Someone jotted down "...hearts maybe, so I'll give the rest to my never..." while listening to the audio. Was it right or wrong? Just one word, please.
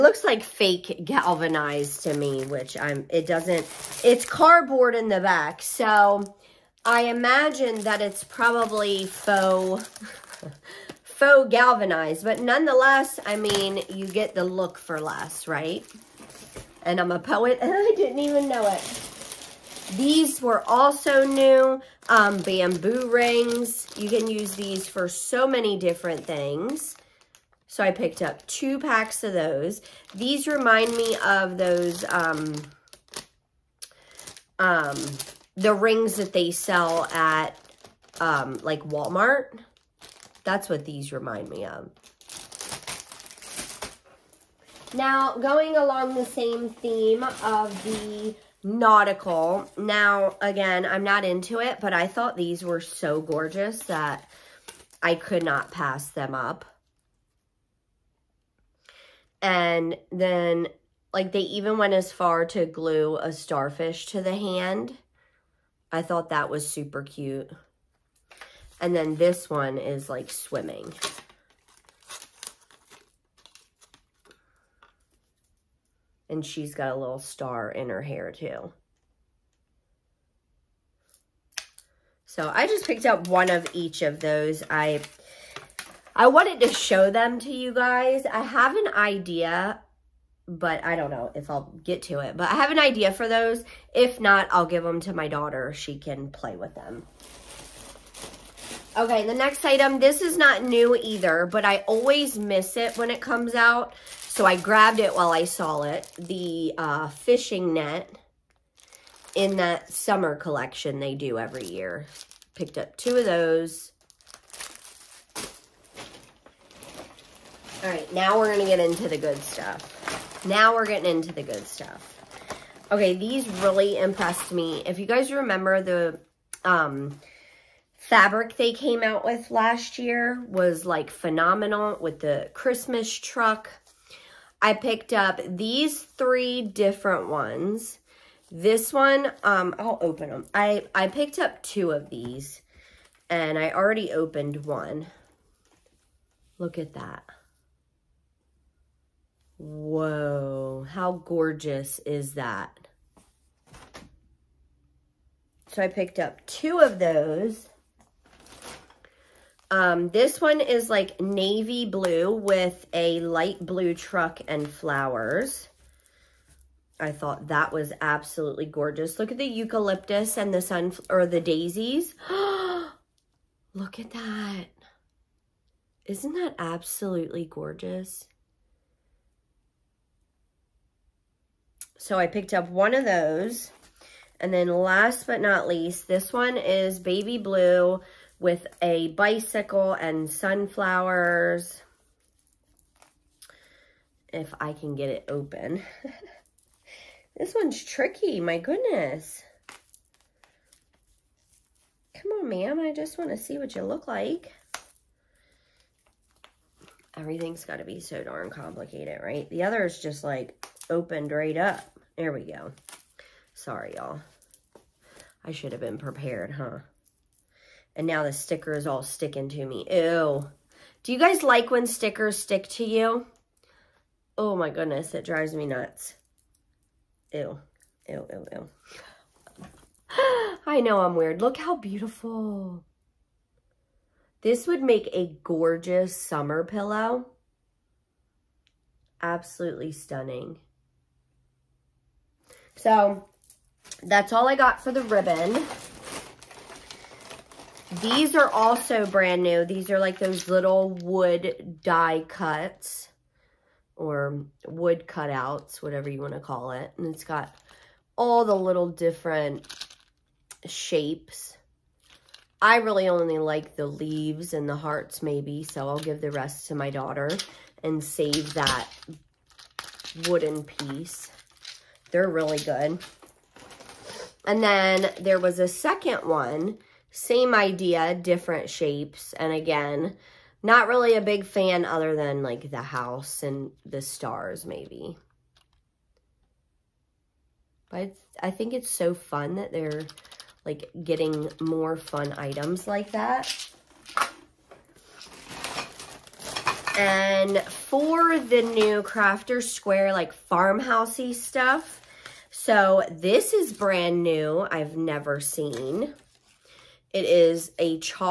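wrong.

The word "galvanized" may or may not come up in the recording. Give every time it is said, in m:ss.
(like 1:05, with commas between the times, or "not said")
0:01, 0:11.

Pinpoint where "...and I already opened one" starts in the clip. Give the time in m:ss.
2:23.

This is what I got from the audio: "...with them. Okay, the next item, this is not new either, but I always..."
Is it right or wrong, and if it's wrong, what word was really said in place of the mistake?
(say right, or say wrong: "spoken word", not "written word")
right.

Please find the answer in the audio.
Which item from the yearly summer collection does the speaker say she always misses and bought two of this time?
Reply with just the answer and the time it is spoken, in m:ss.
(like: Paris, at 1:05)
Fishing net, at 1:47.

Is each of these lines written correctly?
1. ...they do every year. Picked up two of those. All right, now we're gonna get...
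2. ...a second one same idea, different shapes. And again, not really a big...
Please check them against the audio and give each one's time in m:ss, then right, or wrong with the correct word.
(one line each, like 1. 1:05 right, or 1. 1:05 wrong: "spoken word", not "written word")
1. 1:50 right
2. 4:35 right.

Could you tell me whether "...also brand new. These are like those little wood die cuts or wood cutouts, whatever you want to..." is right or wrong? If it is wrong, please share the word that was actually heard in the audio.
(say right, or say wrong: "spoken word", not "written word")
right.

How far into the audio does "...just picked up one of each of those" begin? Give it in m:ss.
1:22.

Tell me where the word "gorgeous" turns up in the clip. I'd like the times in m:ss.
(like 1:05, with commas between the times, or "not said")
0:53, 2:31, 2:48, 2:57, 3:55.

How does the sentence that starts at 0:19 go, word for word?
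These were also new um, bamboo rings.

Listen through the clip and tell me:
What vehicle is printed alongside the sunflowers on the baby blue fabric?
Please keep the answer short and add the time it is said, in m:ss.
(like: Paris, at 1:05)
Bicycle, at 3:09.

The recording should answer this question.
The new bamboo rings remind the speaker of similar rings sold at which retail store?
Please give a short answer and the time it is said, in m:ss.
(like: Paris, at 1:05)
Walmart, at 0:38.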